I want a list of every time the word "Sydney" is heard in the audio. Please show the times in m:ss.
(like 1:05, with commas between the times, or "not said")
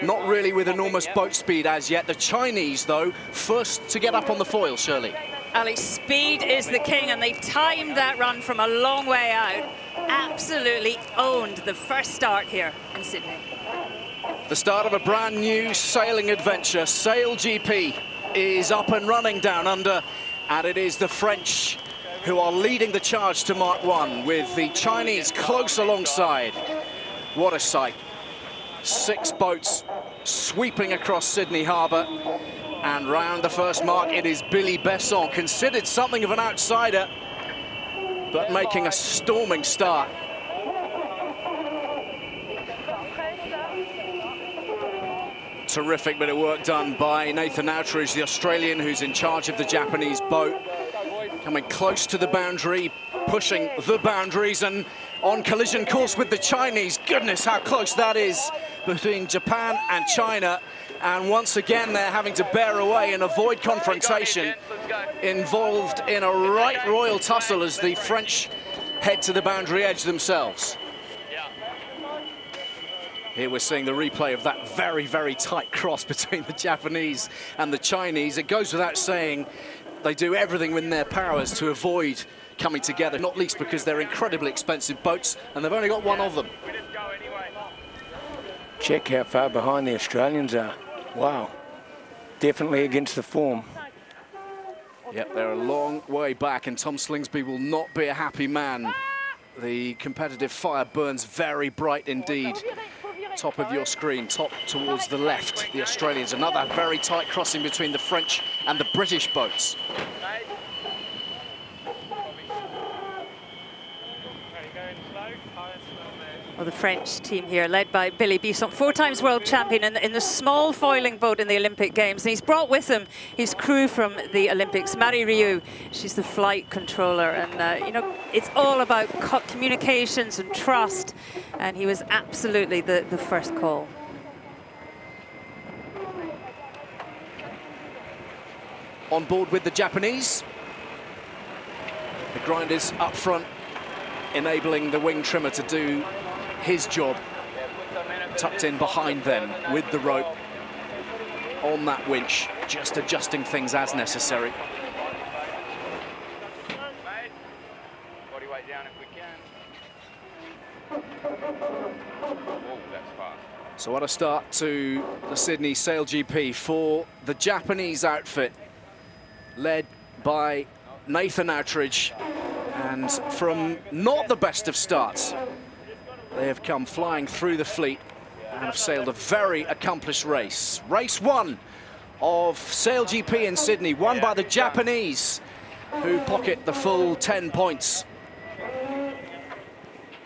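0:13, 0:31, 2:45, 3:03.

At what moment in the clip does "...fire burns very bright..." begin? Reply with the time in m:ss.
1:40.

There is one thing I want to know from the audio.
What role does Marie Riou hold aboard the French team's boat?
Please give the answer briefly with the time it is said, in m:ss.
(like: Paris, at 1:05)
Flight controller, at 2:06.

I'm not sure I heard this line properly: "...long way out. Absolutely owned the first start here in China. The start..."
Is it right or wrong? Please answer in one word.
wrong.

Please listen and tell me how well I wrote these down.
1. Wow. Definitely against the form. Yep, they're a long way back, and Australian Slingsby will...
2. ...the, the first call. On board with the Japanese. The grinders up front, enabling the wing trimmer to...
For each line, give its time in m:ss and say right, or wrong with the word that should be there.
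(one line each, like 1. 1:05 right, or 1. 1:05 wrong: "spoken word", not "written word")
1. 1:31 wrong: "Tom", not "Australian"
2. 2:12 right.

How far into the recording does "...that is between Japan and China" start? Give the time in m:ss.
0:57.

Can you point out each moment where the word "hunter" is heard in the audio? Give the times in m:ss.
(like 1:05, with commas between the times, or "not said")
not said.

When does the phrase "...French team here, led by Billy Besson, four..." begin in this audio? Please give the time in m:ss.
1:56.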